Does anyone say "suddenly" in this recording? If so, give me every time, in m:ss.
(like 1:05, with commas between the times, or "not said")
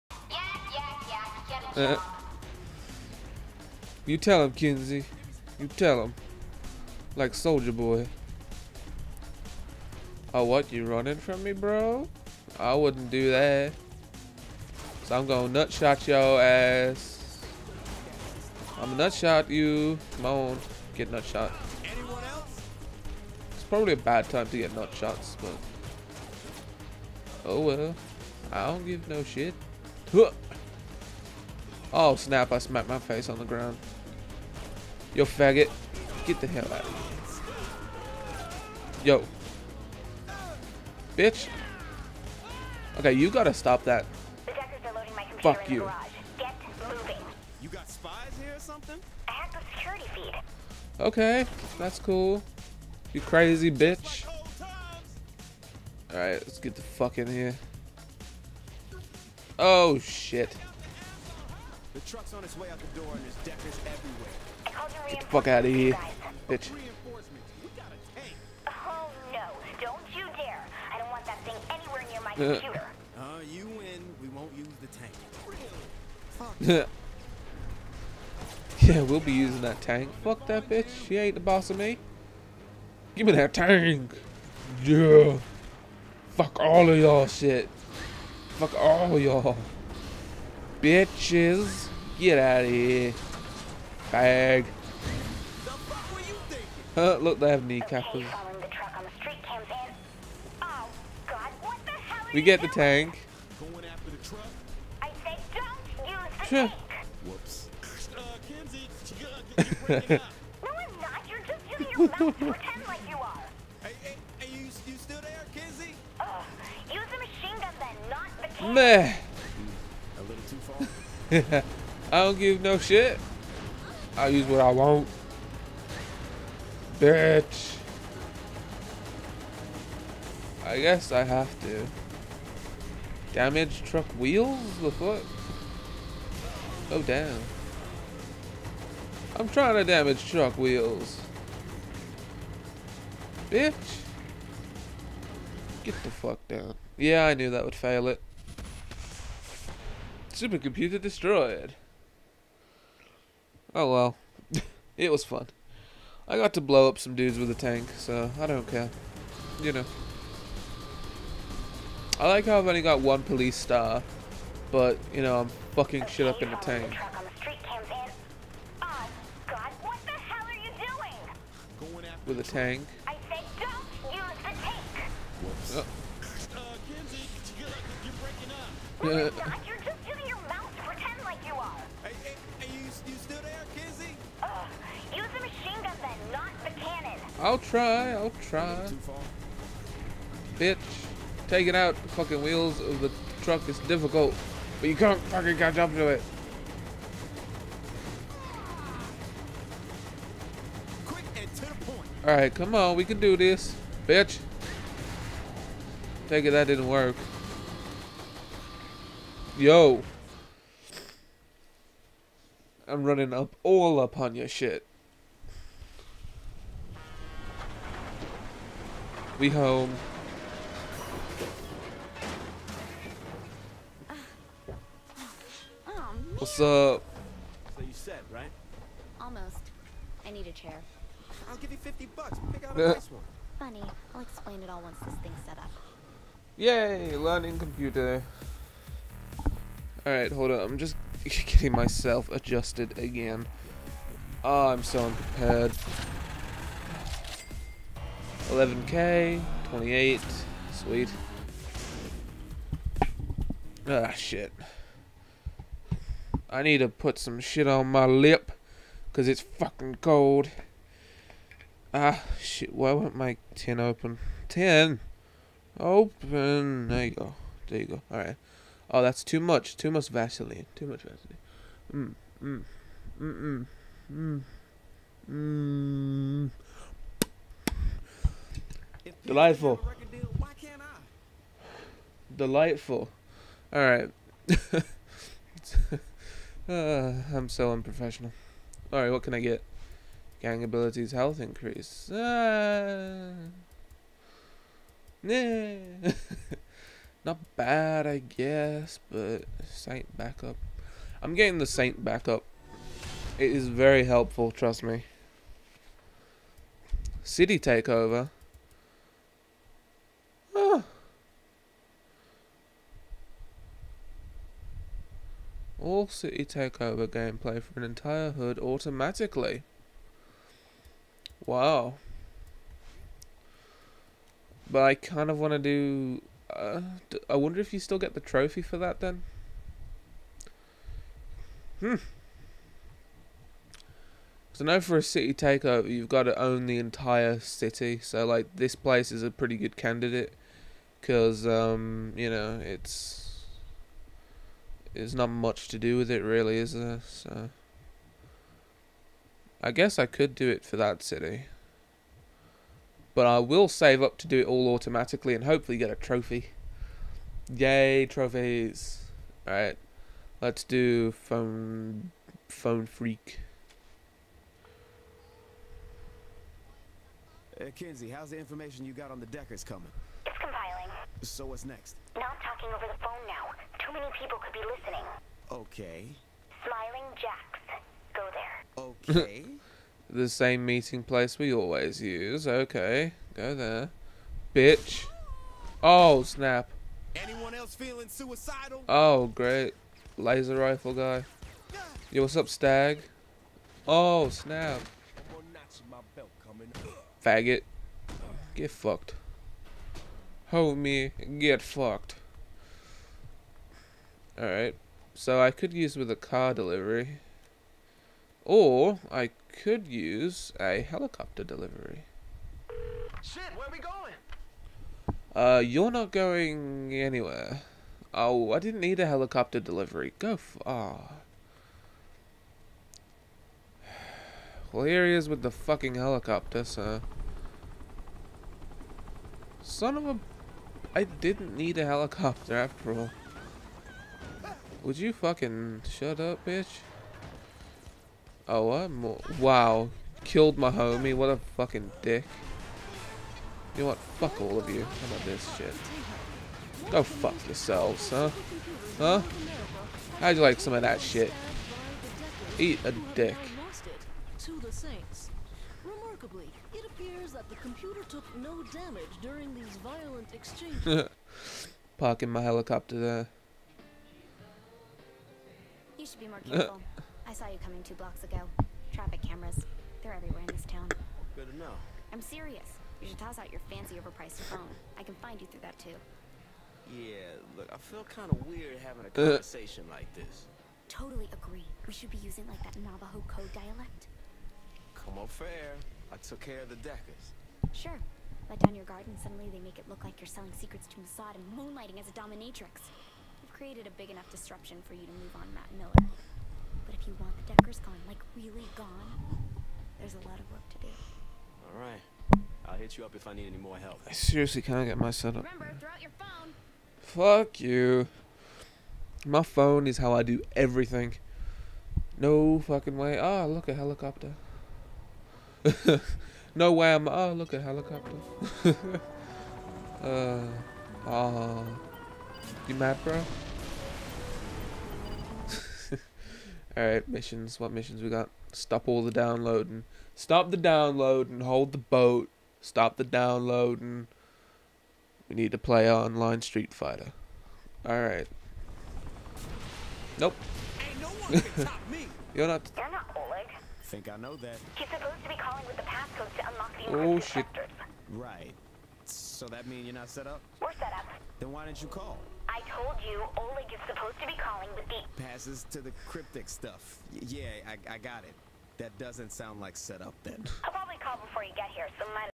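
8:09.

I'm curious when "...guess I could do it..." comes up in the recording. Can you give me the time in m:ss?
5:49.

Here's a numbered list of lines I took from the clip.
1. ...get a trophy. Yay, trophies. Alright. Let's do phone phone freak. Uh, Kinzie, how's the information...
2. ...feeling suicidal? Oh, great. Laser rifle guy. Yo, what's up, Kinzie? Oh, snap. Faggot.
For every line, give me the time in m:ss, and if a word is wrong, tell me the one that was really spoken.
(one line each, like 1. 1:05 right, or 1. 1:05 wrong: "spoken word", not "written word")
1. 5:55 right
2. 6:27 wrong: "Stag", not "Kinzie".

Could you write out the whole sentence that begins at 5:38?
So, like, this place is a pretty good candidate.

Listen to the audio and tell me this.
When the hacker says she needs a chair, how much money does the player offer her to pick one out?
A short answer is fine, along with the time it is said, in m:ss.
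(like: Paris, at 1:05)
50 bucks, at 3:51.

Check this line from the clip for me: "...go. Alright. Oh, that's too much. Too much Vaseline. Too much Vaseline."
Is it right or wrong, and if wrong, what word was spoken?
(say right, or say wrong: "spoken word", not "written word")
right.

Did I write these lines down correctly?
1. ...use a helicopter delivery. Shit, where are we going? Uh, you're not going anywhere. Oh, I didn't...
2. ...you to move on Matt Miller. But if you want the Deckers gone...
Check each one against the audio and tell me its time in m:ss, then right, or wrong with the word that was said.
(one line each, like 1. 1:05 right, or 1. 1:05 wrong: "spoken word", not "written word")
1. 6:49 right
2. 8:14 right.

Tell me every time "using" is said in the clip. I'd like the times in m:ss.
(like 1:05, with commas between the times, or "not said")
1:19, 8:02.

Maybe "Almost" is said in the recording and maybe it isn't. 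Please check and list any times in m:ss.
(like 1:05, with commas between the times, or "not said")
3:49.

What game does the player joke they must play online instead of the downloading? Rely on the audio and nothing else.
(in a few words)
Street Fighter.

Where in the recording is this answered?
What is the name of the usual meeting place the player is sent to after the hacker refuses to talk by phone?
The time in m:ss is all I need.
6:16.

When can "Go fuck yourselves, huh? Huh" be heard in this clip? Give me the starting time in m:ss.
7:26.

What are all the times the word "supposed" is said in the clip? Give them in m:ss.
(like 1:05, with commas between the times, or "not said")
9:04, 9:13.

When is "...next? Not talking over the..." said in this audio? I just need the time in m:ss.
6:11.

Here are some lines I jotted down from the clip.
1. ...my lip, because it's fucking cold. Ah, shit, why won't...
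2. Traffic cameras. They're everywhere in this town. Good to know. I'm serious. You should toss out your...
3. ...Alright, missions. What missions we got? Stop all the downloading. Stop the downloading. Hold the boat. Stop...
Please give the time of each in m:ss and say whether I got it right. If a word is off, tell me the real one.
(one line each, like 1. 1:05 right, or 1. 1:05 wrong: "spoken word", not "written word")
1. 4:17 right
2. 7:48 right
3. 8:46 right.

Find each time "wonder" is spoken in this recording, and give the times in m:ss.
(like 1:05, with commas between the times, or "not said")
5:27.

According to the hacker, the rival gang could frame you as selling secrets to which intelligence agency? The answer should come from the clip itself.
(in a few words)
Mossad.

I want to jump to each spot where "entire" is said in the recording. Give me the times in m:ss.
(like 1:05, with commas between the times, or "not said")
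5:17, 5:36.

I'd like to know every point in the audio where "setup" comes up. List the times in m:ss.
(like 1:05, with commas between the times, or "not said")
8:25, 9:19.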